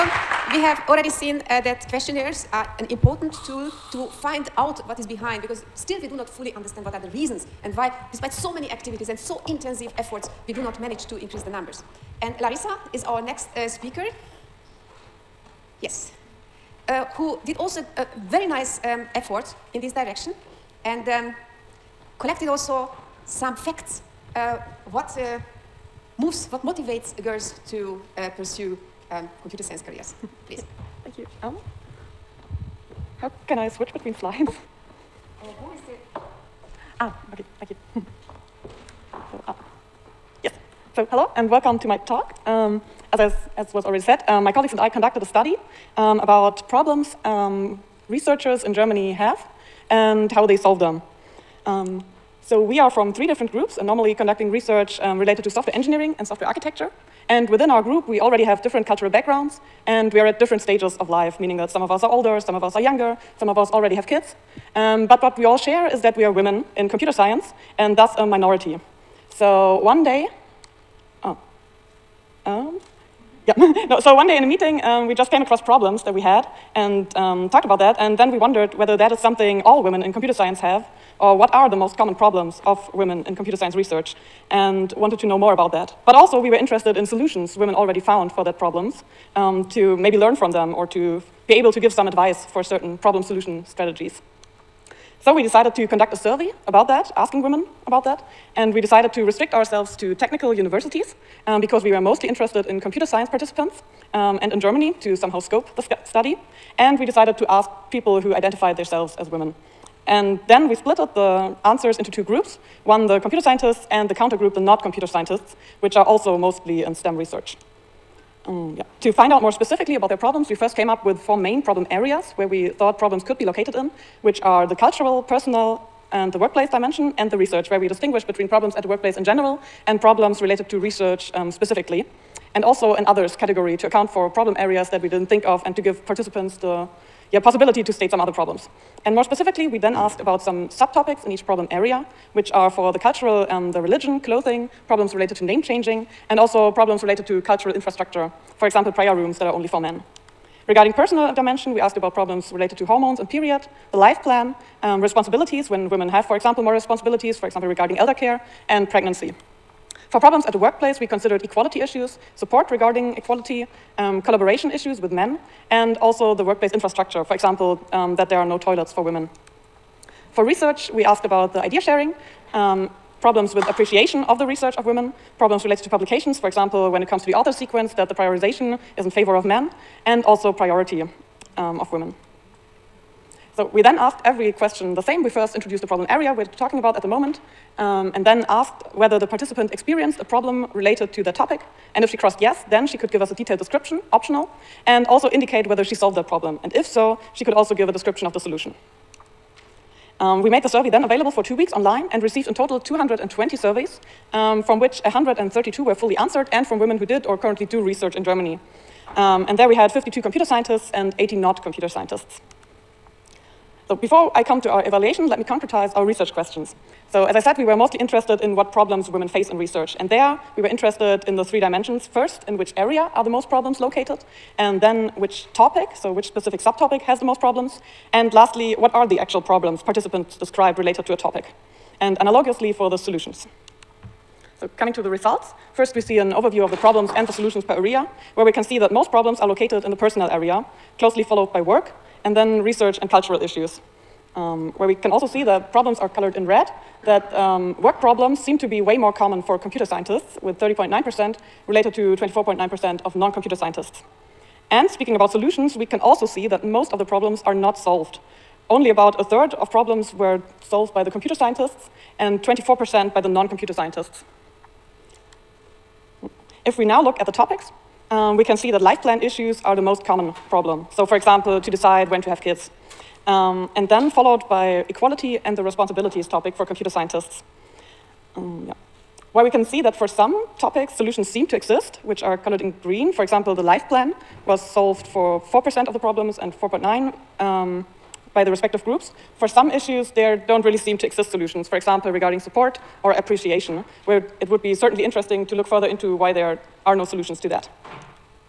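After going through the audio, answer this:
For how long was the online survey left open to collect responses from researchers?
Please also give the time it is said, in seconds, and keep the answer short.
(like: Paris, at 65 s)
2 weeks, at 201 s.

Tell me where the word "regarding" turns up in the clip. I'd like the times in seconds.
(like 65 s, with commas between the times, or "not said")
150 s, 157 s, 162 s, 292 s.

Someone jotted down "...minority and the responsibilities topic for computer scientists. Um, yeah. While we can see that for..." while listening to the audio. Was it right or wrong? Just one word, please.
wrong.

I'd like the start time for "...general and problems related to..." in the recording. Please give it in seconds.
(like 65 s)
129 s.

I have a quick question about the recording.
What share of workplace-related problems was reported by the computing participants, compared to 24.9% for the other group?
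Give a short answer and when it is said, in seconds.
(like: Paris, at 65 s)
30.9%, at 250 s.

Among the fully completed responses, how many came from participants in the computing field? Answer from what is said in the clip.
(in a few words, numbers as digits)
52.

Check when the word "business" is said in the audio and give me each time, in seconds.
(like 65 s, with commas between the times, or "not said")
not said.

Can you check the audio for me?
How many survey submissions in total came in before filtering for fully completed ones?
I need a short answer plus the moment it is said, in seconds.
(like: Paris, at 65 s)
220, at 202 s.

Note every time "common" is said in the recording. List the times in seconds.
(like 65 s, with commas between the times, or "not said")
81 s, 249 s, 270 s.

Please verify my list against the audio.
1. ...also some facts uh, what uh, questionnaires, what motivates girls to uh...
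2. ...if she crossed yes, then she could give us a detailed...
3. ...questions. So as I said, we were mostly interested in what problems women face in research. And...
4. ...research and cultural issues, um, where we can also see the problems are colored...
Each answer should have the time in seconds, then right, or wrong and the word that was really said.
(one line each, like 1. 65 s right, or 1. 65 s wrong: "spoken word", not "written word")
1. 22 s wrong: "moves", not "questionnaires"
2. 192 s right
3. 216 s right
4. 242 s right.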